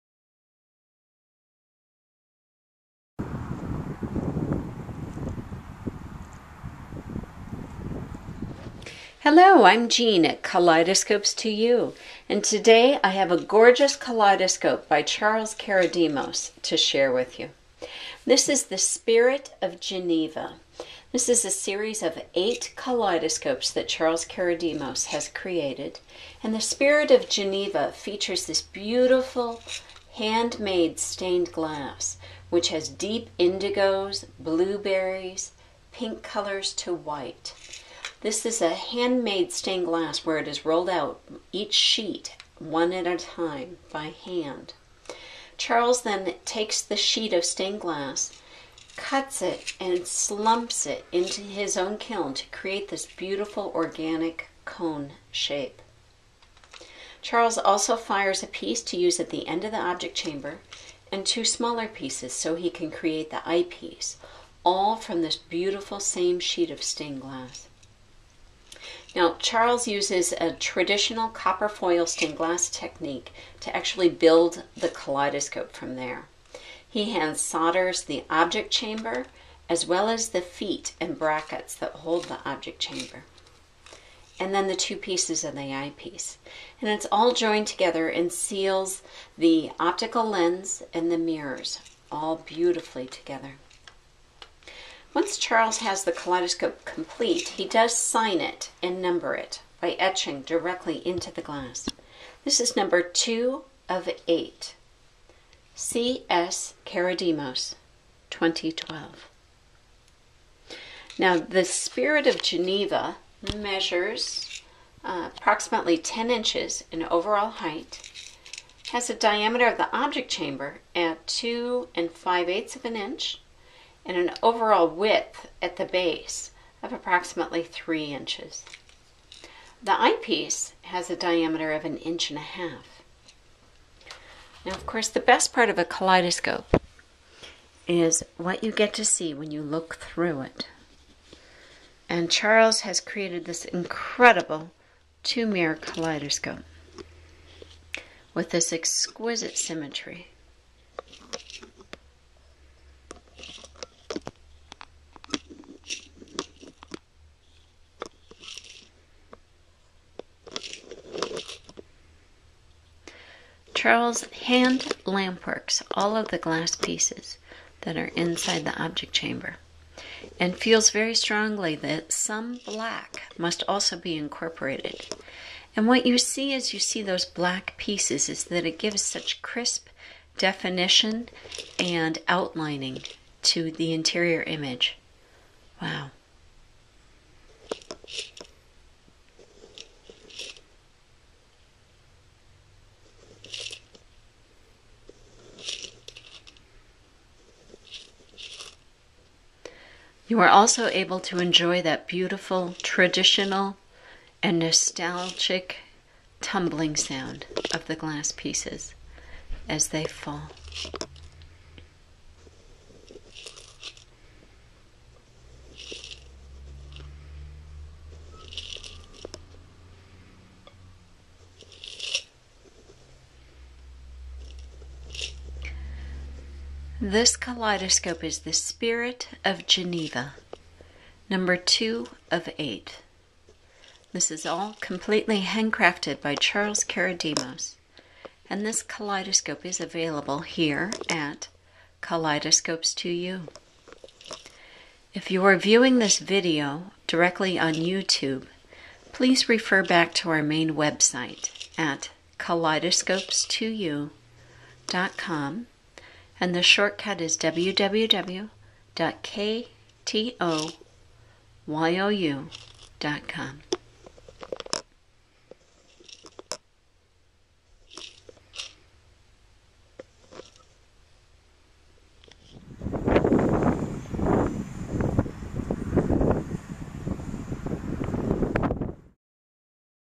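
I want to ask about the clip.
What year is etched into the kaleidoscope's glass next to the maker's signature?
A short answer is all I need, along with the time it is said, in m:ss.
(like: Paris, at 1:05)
2012, at 1:48.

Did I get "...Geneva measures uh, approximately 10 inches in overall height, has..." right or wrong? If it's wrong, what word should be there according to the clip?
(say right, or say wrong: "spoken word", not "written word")
right.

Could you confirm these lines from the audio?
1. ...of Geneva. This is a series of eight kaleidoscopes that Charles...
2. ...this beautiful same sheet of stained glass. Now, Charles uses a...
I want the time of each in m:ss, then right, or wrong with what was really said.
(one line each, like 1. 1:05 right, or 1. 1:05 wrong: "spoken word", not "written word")
1. 0:19 right
2. 1:05 right.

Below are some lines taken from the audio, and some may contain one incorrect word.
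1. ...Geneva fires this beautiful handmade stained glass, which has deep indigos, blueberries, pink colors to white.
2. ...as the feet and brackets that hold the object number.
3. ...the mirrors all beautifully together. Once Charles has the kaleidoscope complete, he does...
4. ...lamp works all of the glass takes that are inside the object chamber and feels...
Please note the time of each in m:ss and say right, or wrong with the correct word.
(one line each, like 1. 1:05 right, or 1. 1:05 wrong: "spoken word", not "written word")
1. 0:27 wrong: "features", not "fires"
2. 1:20 wrong: "chamber", not "number"
3. 1:31 right
4. 2:45 wrong: "pieces", not "takes".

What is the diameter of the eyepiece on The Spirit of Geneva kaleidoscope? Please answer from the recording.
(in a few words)
1.5 inches.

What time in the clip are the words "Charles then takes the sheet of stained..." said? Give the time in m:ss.
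0:45.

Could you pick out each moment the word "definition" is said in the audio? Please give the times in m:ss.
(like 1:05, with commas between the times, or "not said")
3:00.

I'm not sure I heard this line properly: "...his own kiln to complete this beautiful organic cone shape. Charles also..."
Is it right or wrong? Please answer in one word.
wrong.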